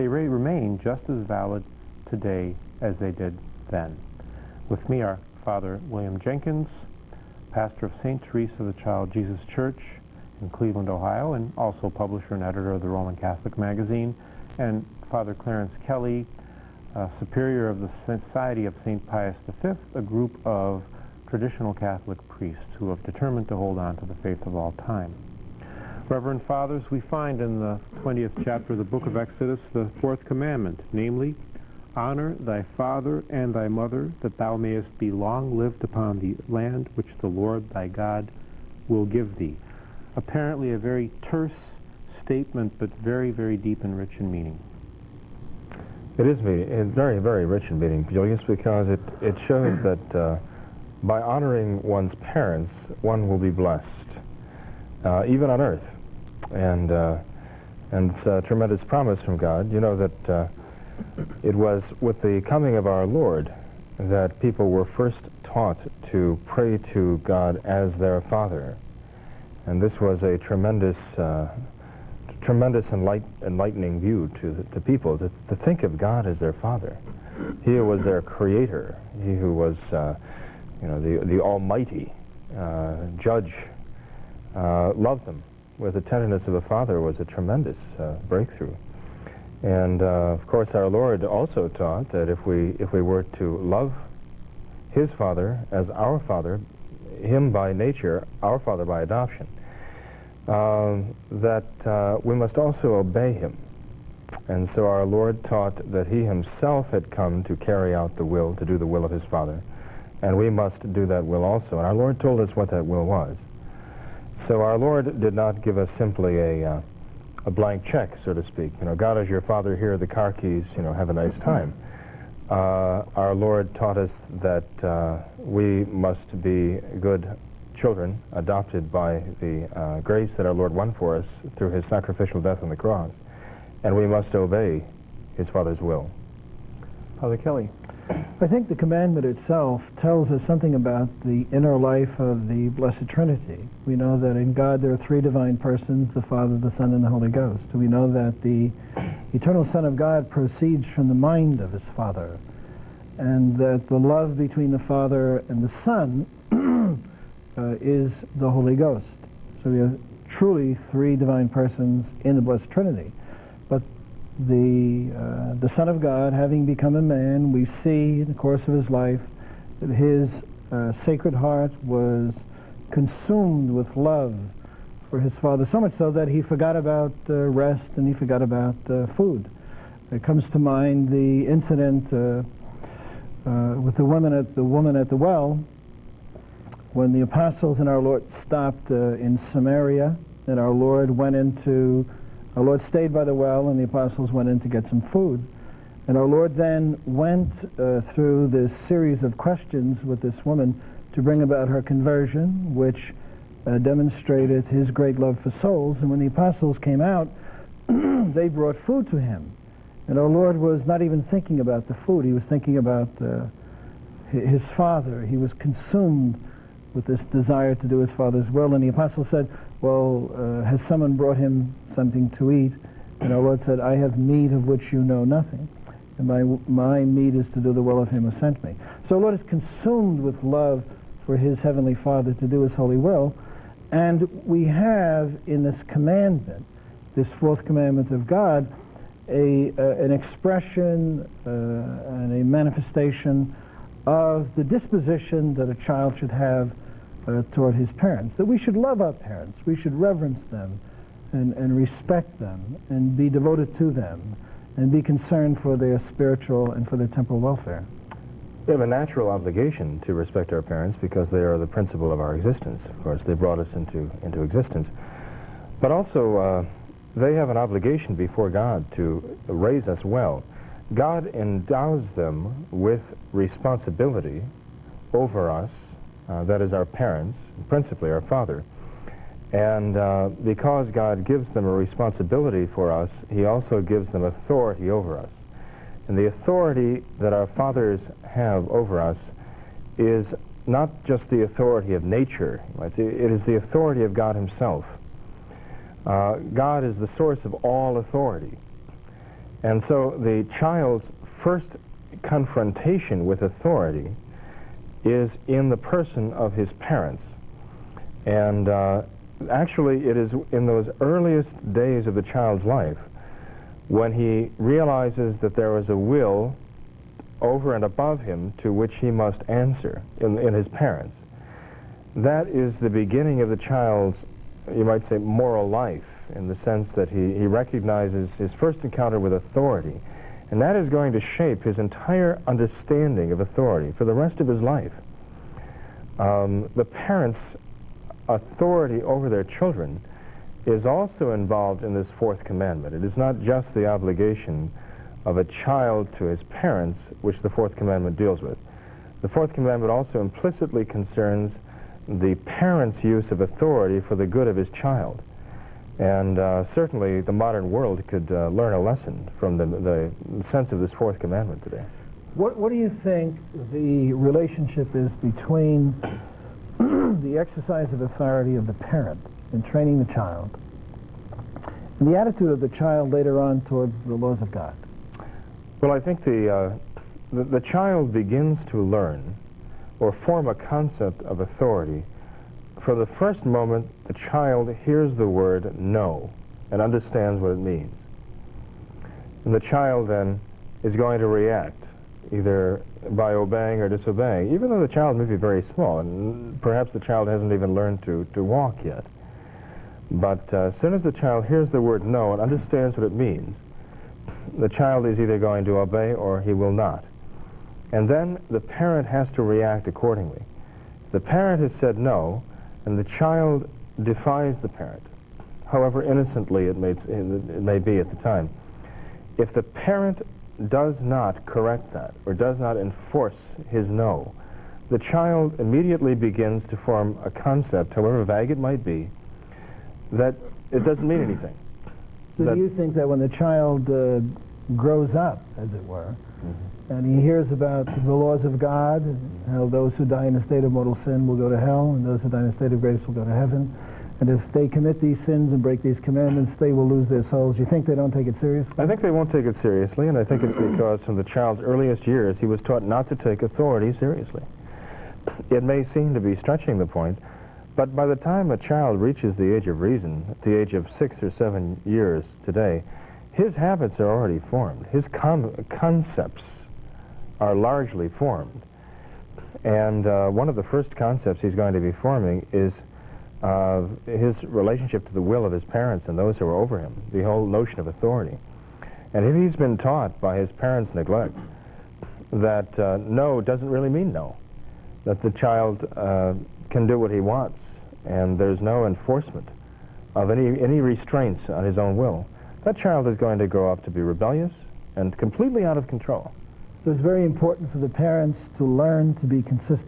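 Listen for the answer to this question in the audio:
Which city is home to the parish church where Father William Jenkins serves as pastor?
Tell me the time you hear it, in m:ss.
0:10.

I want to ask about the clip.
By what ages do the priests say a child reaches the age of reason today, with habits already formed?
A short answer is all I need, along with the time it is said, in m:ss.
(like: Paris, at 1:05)
6 or 7, at 7:40.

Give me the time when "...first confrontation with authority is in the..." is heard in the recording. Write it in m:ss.
5:01.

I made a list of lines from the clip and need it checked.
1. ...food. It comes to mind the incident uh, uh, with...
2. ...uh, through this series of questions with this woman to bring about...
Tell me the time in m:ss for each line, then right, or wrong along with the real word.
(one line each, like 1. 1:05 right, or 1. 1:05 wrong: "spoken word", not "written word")
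1. 2:59 right
2. 3:17 right.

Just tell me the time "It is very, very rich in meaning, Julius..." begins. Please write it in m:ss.
0:46.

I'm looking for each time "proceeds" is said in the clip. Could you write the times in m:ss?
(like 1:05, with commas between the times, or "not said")
2:30.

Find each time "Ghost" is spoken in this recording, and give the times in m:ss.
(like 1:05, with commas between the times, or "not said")
2:27, 2:38.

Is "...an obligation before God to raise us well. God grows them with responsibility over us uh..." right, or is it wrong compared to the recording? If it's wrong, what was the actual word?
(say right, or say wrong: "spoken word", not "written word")
wrong: "endows", not "grows".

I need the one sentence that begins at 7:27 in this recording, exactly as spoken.
You think they don't take it seriously?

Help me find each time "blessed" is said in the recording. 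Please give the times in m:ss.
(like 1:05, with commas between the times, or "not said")
0:53, 2:22, 2:42.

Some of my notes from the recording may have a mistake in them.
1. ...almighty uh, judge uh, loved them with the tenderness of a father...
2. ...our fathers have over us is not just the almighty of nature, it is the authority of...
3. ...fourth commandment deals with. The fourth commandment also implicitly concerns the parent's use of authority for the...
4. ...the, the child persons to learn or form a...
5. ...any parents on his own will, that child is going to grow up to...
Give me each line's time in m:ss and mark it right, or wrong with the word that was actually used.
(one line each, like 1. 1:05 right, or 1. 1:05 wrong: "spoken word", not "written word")
1. 1:21 right
2. 4:47 wrong: "authority", not "almighty"
3. 5:47 right
4. 6:17 wrong: "begins", not "persons"
5. 8:10 wrong: "restraints", not "parents".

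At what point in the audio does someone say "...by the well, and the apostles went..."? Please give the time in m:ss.
3:13.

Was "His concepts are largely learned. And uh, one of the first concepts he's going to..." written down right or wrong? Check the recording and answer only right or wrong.
wrong.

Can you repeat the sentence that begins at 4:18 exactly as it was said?
We have a natural obligation to respect our parents because they are the principle of our existence.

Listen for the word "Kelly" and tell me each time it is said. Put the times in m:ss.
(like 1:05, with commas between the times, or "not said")
0:15, 2:17.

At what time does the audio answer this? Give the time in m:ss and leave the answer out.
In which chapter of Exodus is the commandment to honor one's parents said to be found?
0:28.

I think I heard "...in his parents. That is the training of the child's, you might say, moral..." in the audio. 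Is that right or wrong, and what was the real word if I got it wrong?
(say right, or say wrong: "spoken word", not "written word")
wrong: "beginning", not "training".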